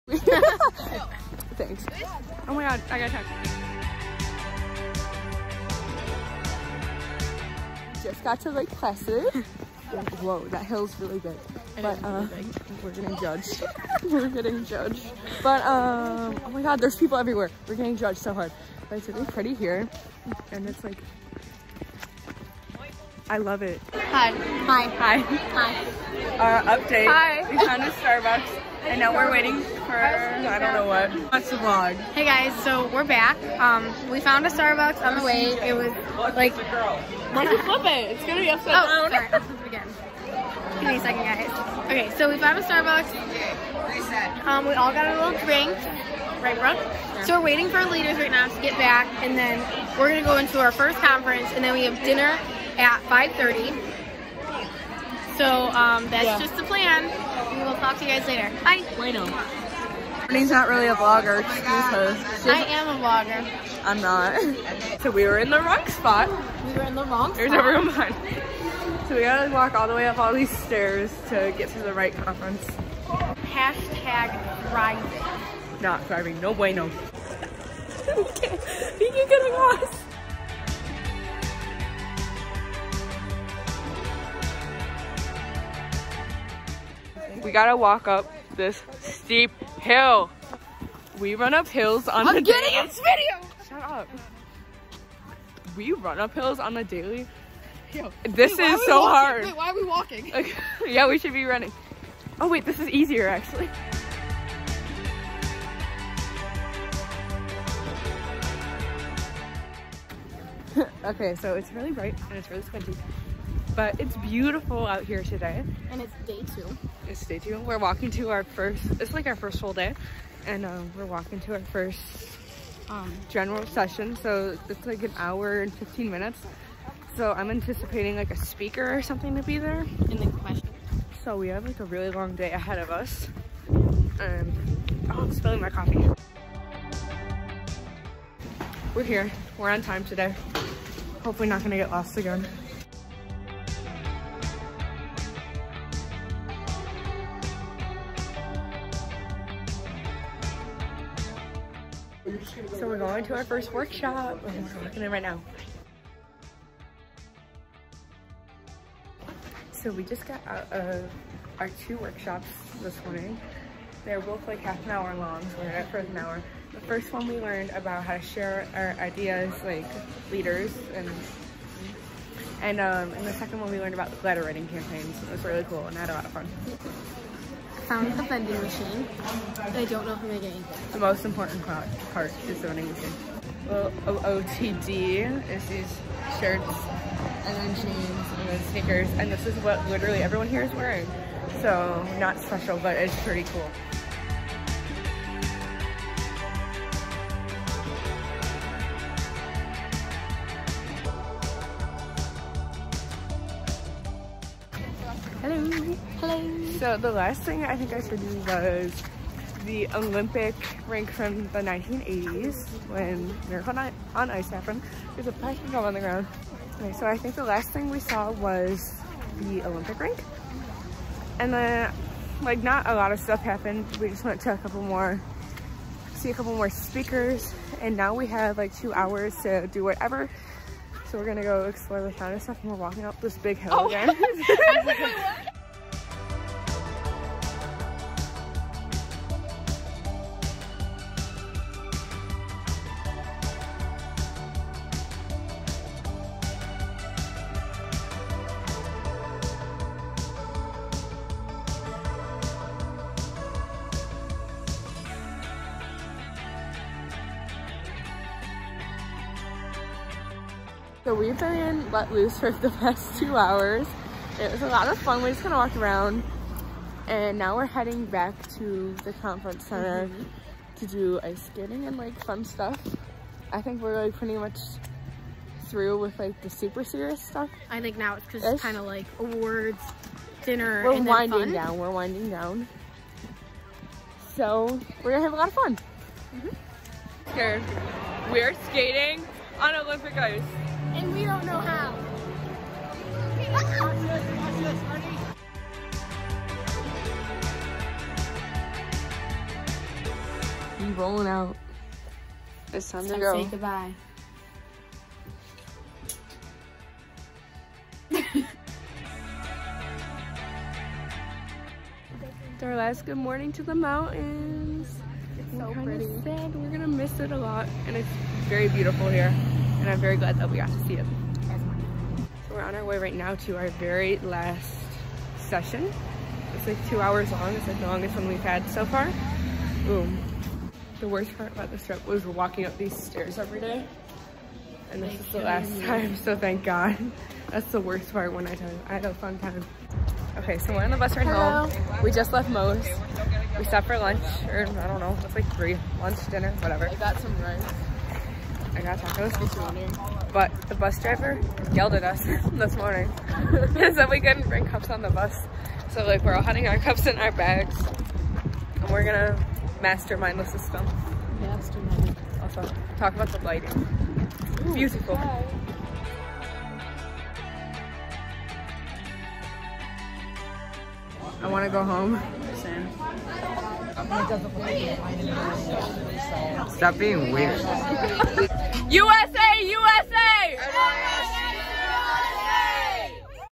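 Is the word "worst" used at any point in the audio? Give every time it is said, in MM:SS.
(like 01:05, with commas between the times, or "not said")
05:31, 05:37.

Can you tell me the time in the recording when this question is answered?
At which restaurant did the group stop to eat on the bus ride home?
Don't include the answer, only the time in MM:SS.
05:42.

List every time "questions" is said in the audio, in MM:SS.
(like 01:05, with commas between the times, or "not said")
02:10.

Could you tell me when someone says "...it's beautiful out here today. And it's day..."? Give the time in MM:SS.
01:54.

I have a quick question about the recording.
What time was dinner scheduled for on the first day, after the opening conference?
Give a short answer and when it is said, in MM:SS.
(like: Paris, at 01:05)
5:30, at 00:53.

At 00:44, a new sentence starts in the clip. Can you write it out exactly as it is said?
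Um, we all got a little drink.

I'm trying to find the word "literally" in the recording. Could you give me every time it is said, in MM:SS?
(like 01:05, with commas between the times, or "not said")
03:09.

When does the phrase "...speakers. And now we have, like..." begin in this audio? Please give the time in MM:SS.
03:46.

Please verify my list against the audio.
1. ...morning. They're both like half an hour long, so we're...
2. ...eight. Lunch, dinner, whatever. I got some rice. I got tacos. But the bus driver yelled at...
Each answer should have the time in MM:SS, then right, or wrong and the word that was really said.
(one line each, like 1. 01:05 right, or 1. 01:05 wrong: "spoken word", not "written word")
1. 02:43 right
2. 05:45 wrong: "three", not "eight".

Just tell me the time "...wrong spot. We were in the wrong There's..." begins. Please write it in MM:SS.
01:05.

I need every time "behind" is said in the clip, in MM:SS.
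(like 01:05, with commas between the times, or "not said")
01:07.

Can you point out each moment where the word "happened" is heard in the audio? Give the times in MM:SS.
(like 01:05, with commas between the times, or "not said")
03:34, 03:43.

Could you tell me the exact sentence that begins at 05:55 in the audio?
So like we're all hiding our cups in our bags.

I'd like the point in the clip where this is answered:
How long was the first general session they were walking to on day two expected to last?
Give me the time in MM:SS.
02:05.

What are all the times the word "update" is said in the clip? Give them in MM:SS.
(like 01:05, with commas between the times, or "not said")
00:26.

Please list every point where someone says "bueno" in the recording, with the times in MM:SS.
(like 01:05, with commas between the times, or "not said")
00:58, 01:16.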